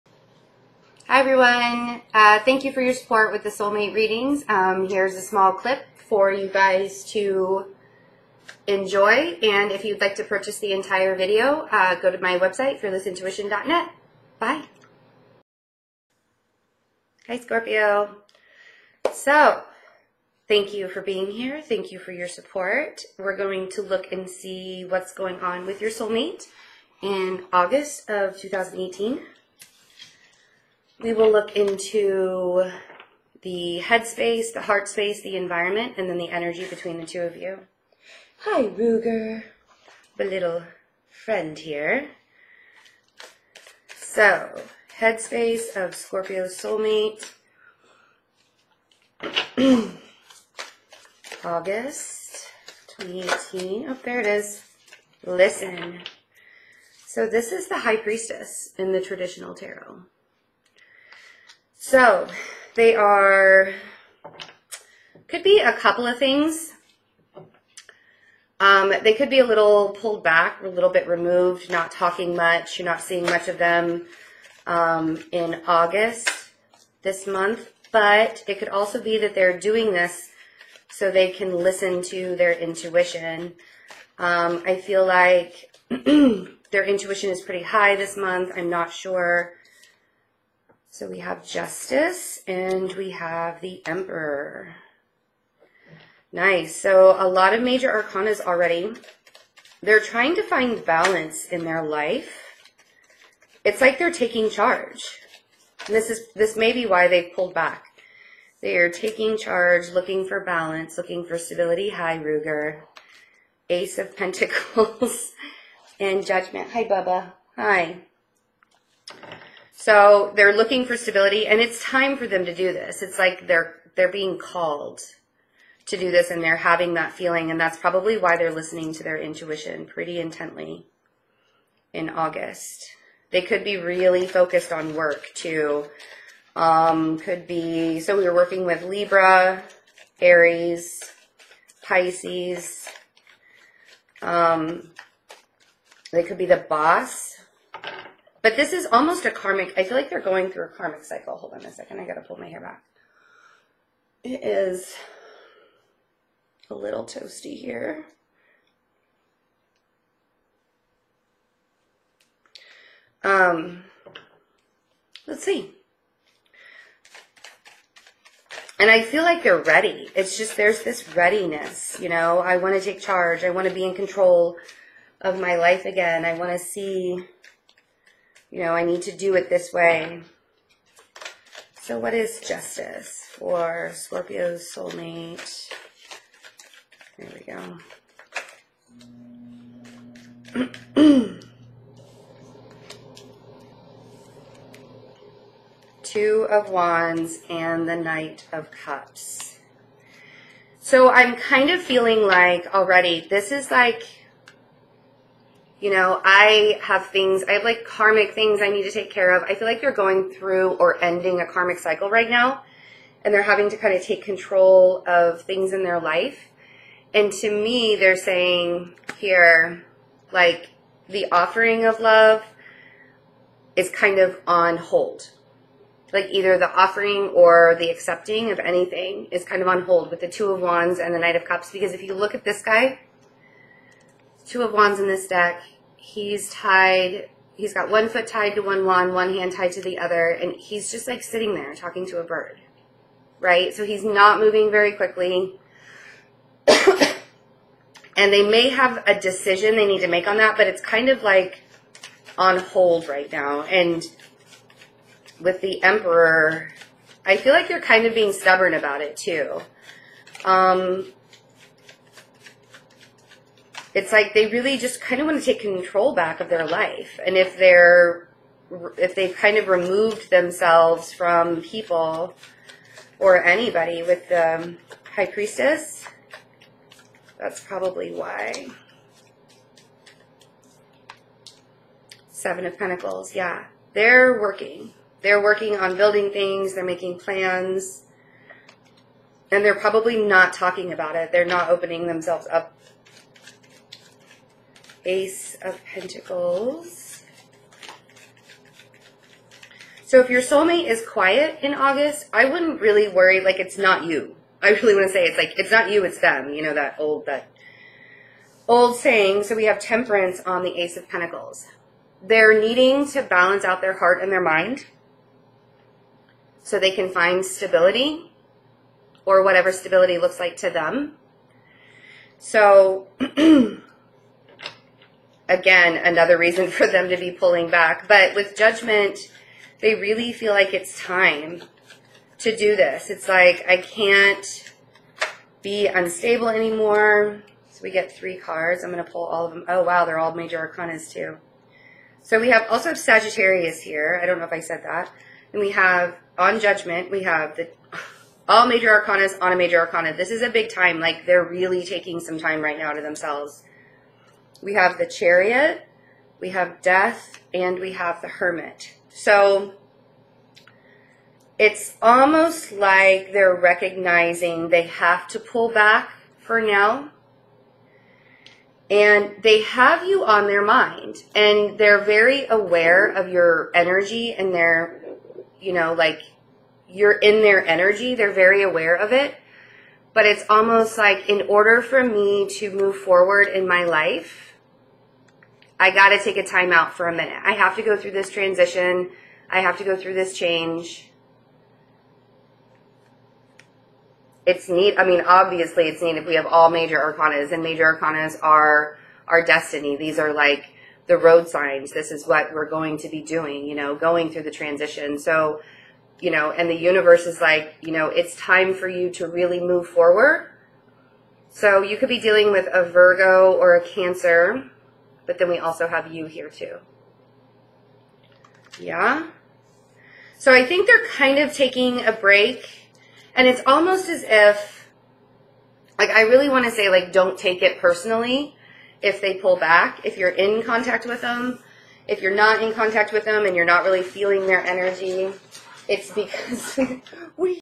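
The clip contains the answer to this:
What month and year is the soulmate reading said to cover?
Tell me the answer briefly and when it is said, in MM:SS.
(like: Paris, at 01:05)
August 2018, at 00:27.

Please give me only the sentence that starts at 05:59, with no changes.
So it's almost like they're recognizing they have to pull back for now.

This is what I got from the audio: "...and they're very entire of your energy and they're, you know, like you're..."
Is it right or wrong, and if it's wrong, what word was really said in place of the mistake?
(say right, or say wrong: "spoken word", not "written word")
wrong: "aware", not "entire".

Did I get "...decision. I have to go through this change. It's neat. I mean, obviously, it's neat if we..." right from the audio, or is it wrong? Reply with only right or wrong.
wrong.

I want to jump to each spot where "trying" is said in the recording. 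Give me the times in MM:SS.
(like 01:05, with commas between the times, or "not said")
01:40.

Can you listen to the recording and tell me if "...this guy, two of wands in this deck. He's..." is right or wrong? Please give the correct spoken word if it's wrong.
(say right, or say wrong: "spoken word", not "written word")
right.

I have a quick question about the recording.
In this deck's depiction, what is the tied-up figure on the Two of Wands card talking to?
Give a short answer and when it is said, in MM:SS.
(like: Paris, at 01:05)
A bird, at 04:02.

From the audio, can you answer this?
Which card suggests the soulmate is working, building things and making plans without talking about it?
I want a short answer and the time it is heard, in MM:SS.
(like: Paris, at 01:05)
Seven of Pentacles, at 04:42.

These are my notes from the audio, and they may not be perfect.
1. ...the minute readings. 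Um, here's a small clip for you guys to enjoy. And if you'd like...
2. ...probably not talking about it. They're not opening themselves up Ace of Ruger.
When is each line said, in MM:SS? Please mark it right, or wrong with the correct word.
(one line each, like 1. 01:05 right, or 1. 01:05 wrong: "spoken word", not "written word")
1. 00:03 wrong: "soulmate", not "minute"
2. 04:49 wrong: "Pentacles", not "Ruger".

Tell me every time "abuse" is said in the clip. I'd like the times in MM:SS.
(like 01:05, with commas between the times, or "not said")
not said.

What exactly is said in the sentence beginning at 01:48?
They are taking charge, looking for balance, looking for stability.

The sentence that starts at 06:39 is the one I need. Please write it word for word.
These are like the road signs.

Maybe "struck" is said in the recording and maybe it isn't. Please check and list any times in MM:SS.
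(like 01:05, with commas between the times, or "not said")
not said.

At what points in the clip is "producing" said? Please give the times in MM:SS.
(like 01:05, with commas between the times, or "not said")
not said.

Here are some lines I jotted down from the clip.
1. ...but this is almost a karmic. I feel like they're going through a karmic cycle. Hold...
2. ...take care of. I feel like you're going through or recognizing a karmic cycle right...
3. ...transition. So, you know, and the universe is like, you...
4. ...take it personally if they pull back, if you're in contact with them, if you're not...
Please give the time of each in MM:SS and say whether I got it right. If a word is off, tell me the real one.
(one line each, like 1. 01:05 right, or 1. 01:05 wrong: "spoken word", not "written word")
1. 02:28 right
2. 03:28 wrong: "ending", not "recognizing"
3. 06:44 right
4. 07:07 right.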